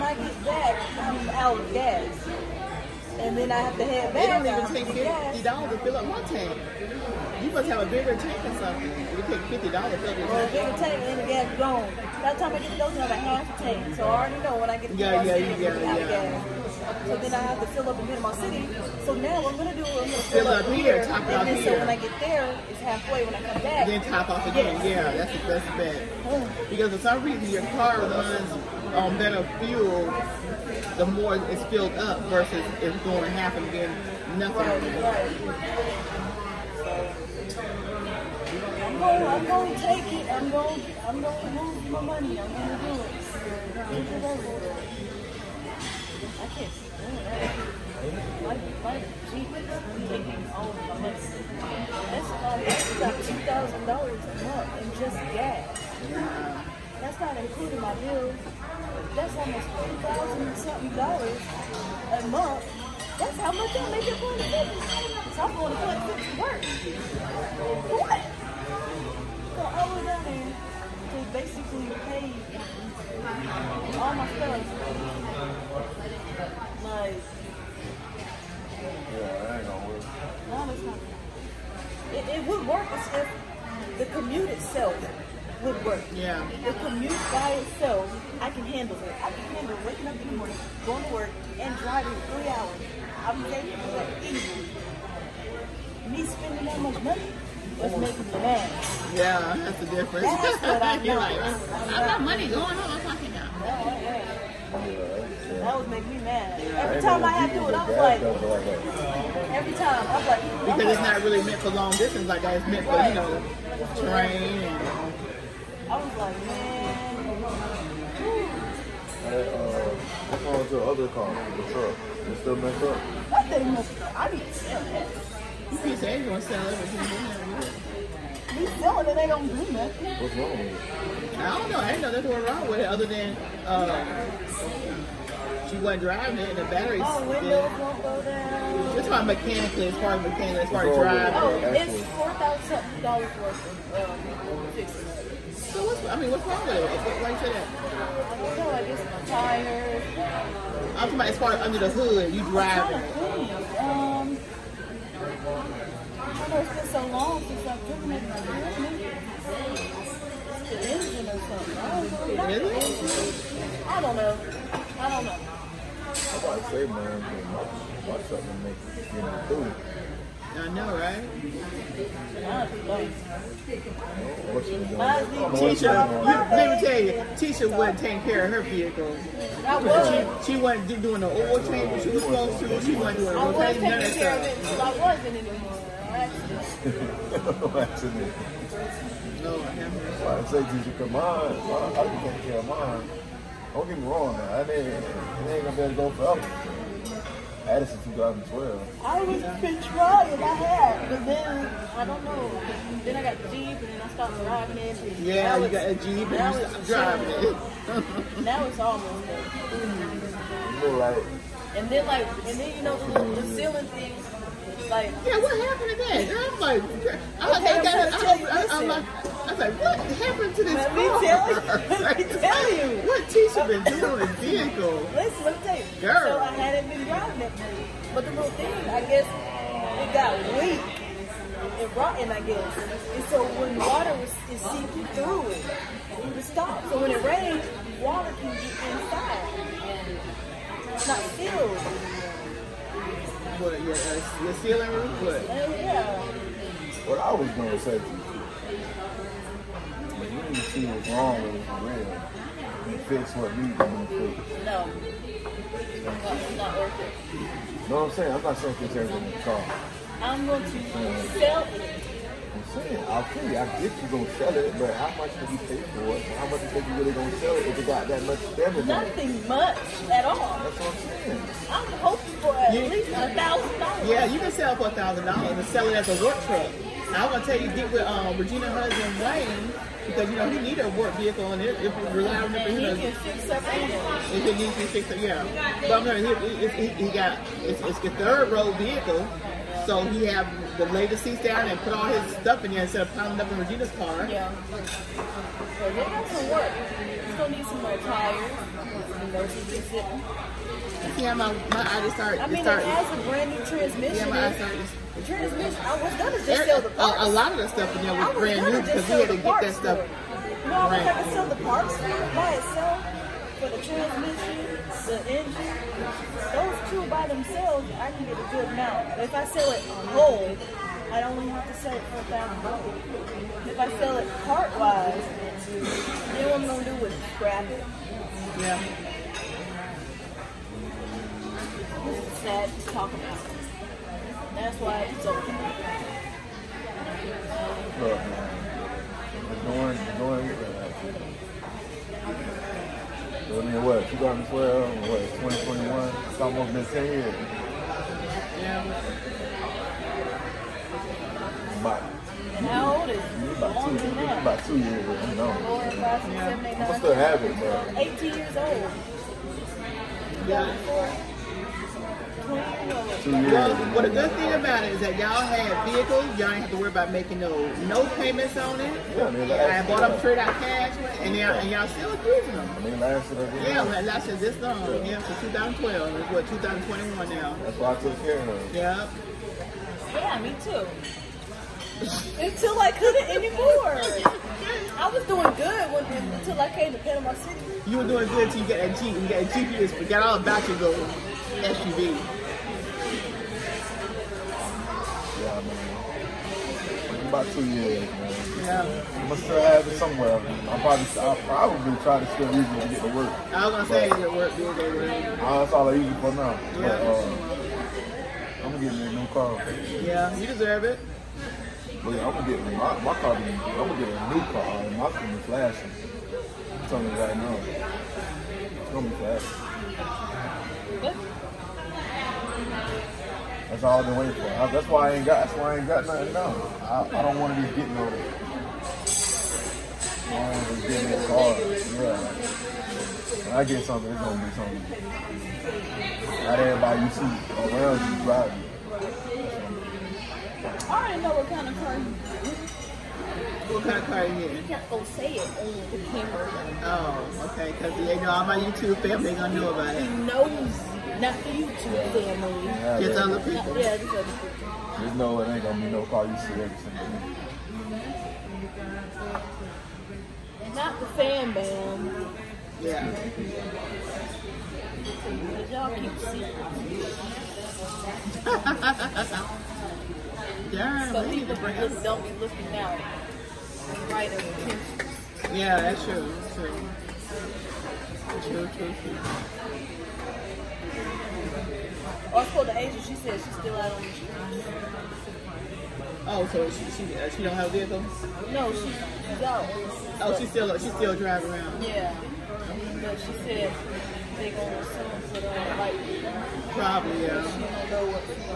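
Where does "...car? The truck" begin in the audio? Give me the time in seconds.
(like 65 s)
121 s.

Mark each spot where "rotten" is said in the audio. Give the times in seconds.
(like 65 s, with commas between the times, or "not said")
231 s.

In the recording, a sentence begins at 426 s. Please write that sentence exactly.
No, I, I don't want to be getting on it.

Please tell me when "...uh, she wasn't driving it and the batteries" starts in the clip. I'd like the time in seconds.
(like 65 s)
133 s.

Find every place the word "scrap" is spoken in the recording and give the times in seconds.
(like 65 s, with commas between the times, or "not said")
327 s.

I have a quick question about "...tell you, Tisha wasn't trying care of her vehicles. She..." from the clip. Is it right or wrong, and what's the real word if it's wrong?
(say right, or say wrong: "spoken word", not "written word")
wrong: "taking", not "trying".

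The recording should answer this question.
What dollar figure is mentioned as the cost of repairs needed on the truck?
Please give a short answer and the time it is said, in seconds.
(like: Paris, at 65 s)
$4,000, at 142 s.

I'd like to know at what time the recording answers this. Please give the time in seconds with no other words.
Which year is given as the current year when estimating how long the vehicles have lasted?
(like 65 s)
376 s.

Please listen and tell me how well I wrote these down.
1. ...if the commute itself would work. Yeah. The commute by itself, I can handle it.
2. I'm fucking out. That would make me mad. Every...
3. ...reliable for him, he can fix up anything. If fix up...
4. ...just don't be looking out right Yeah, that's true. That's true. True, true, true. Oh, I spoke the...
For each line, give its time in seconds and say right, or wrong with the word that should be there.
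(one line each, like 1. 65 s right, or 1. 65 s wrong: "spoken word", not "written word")
1. 82 s right
2. 102 s right
3. 282 s right
4. 471 s right.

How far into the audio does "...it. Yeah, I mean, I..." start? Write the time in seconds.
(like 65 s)
368 s.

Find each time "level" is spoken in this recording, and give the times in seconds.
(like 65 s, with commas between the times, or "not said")
not said.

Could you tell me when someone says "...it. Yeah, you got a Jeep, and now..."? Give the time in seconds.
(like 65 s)
204 s.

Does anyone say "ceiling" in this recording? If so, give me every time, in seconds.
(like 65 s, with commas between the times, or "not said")
213 s, 244 s.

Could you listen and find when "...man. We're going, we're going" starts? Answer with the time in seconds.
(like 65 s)
338 s.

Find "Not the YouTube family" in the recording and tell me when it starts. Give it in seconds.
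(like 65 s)
451 s.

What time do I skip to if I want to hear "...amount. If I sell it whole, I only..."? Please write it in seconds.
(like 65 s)
318 s.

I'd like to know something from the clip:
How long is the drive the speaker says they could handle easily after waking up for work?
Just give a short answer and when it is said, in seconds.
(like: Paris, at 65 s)
3 hours, at 92 s.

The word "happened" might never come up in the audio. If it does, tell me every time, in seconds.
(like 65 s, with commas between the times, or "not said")
215 s, 220 s.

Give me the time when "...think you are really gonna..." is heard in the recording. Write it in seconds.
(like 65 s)
266 s.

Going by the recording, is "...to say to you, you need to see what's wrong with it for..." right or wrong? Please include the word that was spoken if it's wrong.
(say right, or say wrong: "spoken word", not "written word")
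right.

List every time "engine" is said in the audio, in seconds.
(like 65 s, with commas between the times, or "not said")
160 s, 315 s.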